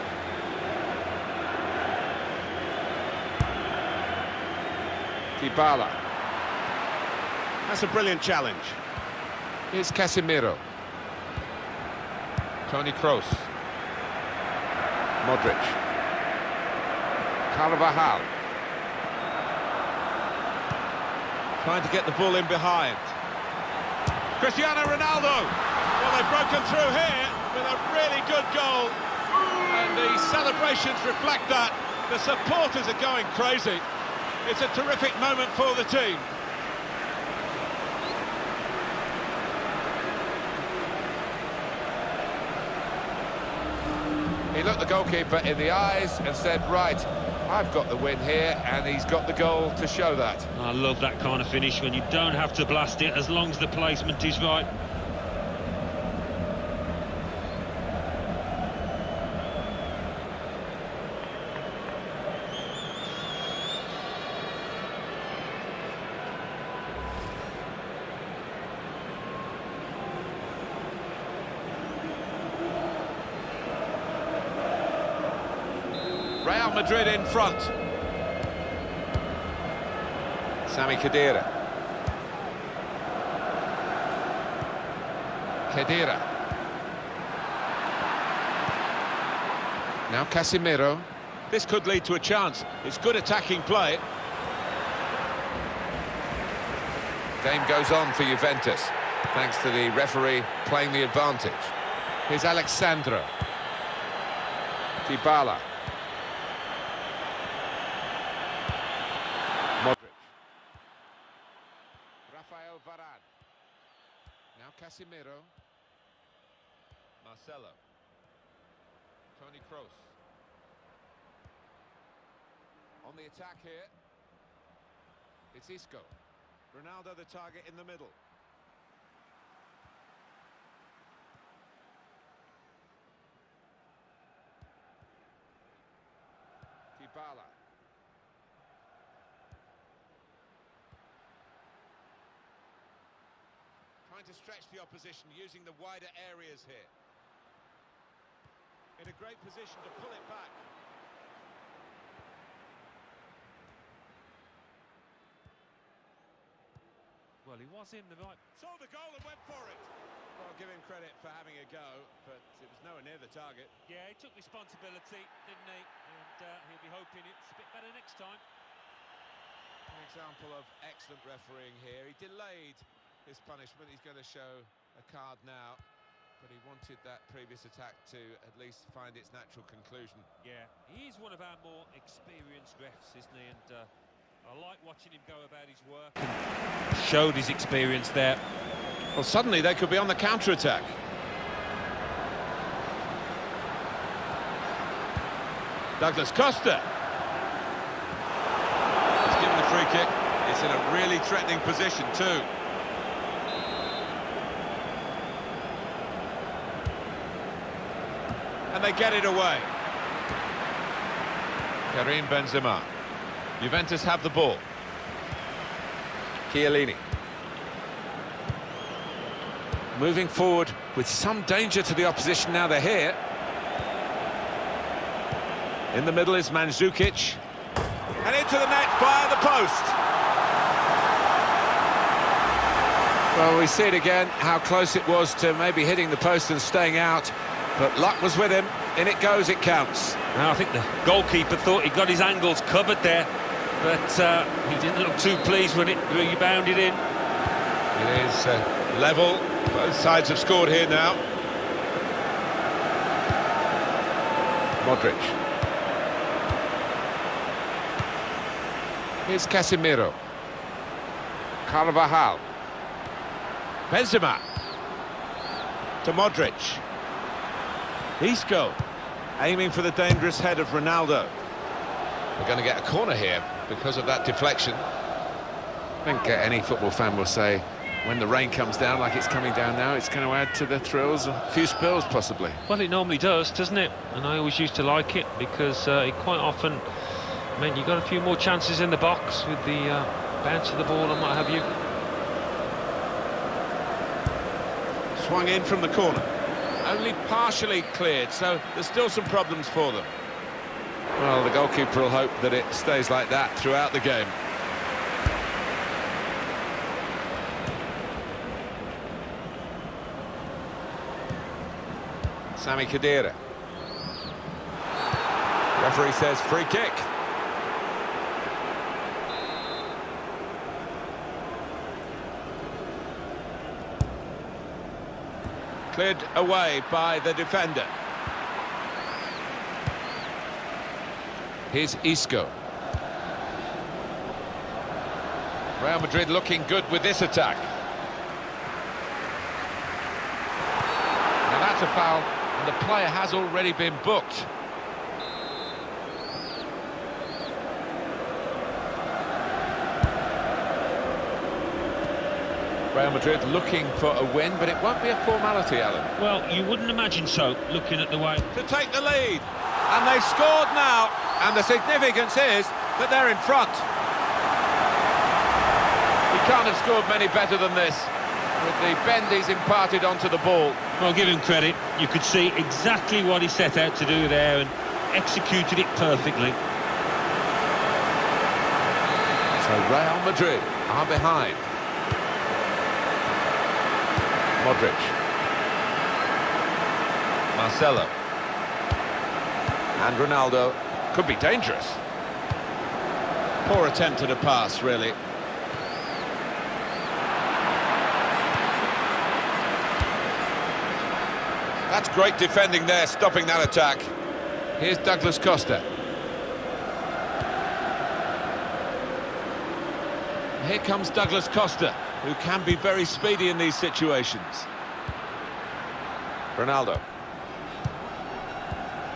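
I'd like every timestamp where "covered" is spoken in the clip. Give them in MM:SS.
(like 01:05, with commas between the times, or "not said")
04:02.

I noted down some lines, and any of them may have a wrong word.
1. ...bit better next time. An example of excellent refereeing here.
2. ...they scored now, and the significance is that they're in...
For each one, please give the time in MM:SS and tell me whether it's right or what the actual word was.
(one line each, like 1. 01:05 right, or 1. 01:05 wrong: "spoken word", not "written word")
1. 02:47 right
2. 06:00 right.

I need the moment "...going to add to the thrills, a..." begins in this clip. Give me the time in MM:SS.
04:40.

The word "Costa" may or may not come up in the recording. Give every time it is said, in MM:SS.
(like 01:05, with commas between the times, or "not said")
03:16, 06:45, 06:51.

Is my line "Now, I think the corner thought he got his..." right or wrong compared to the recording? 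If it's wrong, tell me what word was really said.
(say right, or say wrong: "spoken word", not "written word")
wrong: "goalkeeper", not "corner".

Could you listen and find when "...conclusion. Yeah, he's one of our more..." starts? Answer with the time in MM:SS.
02:59.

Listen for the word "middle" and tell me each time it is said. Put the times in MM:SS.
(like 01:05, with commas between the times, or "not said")
02:07, 03:46.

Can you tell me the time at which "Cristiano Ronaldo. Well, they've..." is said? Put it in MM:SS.
00:24.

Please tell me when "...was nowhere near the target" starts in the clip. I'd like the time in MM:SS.
02:42.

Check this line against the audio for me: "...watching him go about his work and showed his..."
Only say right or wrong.
right.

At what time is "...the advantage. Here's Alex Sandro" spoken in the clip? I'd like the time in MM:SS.
01:40.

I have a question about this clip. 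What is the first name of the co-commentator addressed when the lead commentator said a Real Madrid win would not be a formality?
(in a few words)
Alan.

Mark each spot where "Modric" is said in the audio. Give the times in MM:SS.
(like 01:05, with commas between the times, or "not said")
00:15, 01:49, 04:14, 04:26, 06:24.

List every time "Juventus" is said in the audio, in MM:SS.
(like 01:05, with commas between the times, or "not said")
01:38, 03:33.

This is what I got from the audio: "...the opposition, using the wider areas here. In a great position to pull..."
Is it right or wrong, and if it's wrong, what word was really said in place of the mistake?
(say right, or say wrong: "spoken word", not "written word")
right.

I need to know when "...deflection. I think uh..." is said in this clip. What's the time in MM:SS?
04:34.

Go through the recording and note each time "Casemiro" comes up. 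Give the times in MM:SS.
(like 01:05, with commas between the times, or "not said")
00:09, 01:30, 01:54, 04:19.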